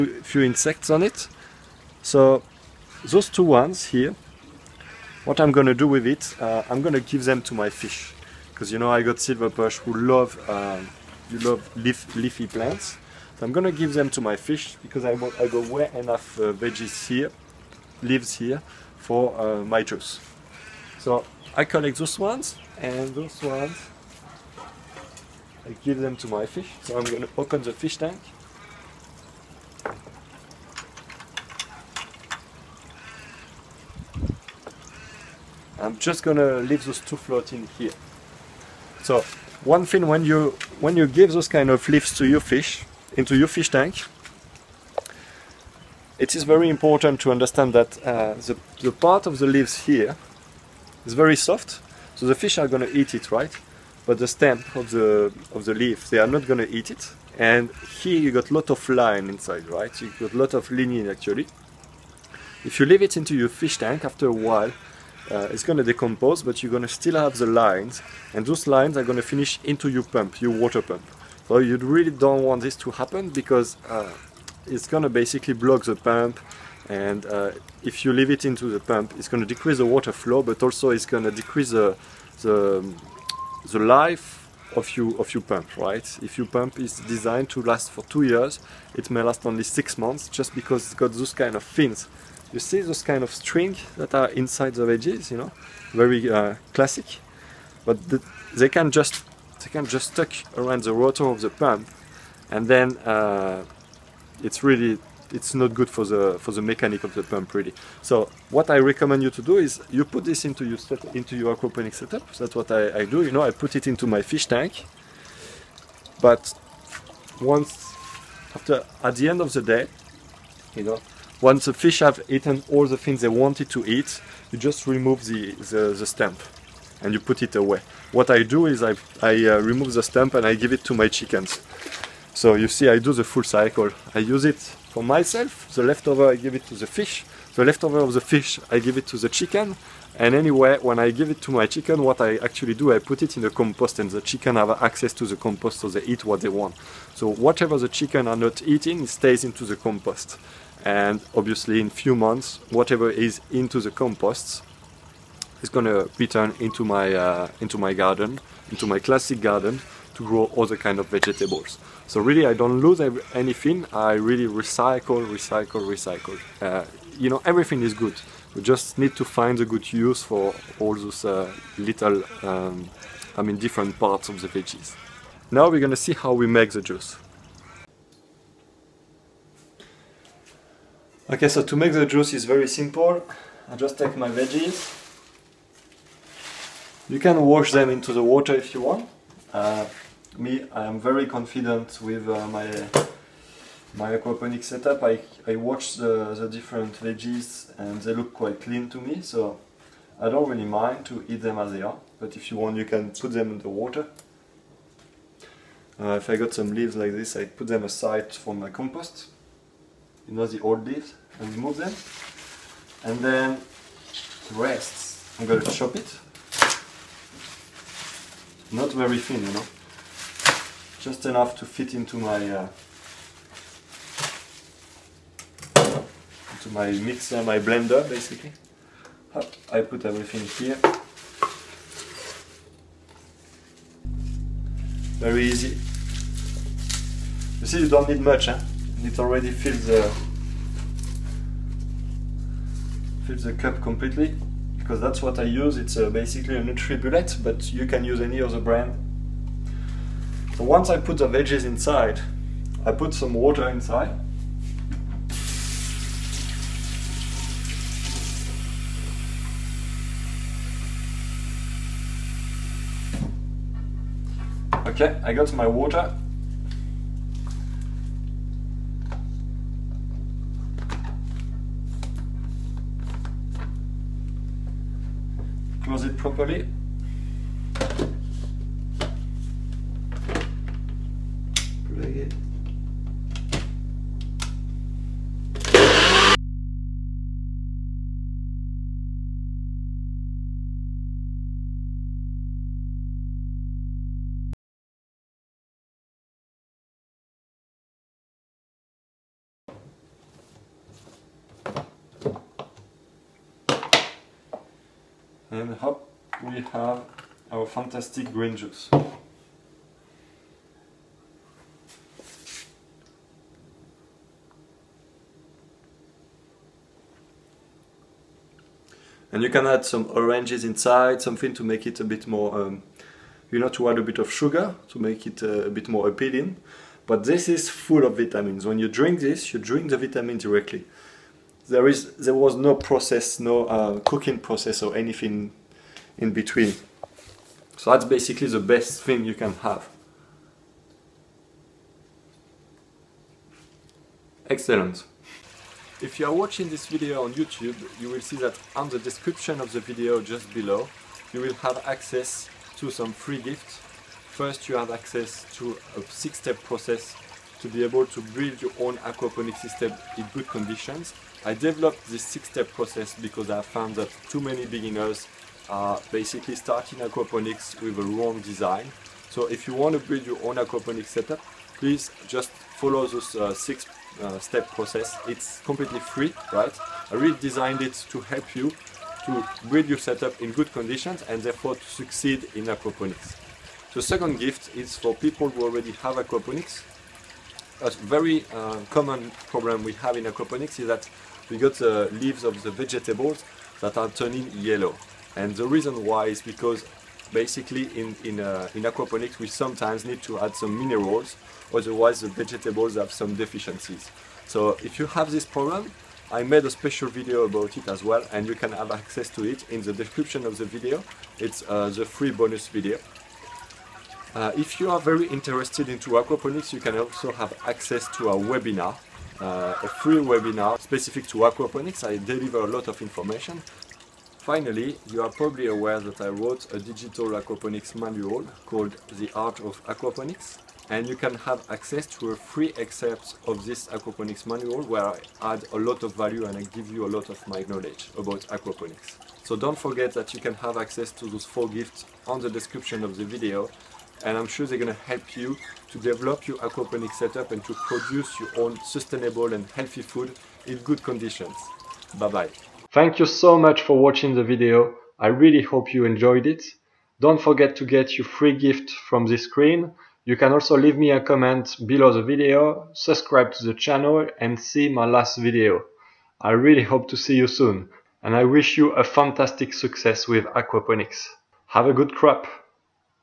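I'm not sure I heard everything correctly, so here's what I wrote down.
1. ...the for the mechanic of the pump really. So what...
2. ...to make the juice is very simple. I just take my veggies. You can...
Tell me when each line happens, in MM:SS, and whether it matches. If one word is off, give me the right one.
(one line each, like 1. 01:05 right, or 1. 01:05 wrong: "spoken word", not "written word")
1. 01:46 right
2. 03:01 right.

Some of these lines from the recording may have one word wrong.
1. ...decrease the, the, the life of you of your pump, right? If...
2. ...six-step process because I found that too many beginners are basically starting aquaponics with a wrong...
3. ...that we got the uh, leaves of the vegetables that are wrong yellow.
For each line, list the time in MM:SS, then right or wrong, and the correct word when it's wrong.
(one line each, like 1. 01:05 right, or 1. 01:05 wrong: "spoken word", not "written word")
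1. 01:21 right
2. 06:02 right
3. 06:30 wrong: "turning", not "wrong".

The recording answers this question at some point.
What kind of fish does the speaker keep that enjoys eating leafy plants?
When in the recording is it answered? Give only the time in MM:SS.
00:09.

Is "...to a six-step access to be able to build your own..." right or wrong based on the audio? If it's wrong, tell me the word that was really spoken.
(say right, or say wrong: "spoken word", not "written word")
wrong: "process", not "access".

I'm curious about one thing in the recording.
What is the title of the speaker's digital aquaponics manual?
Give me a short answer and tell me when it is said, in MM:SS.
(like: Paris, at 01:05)
The Art of Aquaponics, at 07:09.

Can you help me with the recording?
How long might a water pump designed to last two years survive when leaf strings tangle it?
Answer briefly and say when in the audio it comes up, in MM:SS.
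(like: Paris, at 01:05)
6 months, at 01:29.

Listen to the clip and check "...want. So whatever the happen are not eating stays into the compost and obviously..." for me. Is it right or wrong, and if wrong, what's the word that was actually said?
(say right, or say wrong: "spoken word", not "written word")
wrong: "chicken", not "happen".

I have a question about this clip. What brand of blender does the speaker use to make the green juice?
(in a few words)
Nutribullet.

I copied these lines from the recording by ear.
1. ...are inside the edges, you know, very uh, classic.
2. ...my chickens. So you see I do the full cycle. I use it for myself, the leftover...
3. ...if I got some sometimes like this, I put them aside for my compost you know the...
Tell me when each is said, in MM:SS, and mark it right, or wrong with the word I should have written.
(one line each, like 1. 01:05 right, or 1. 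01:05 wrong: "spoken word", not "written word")
1. 01:34 right
2. 02:10 right
3. 03:26 wrong: "leaves", not "sometimes".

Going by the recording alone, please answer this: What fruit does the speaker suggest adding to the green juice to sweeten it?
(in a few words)
Oranges.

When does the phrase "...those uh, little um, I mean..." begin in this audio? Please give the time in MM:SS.
02:50.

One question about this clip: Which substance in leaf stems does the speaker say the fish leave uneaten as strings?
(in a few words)
Lignin.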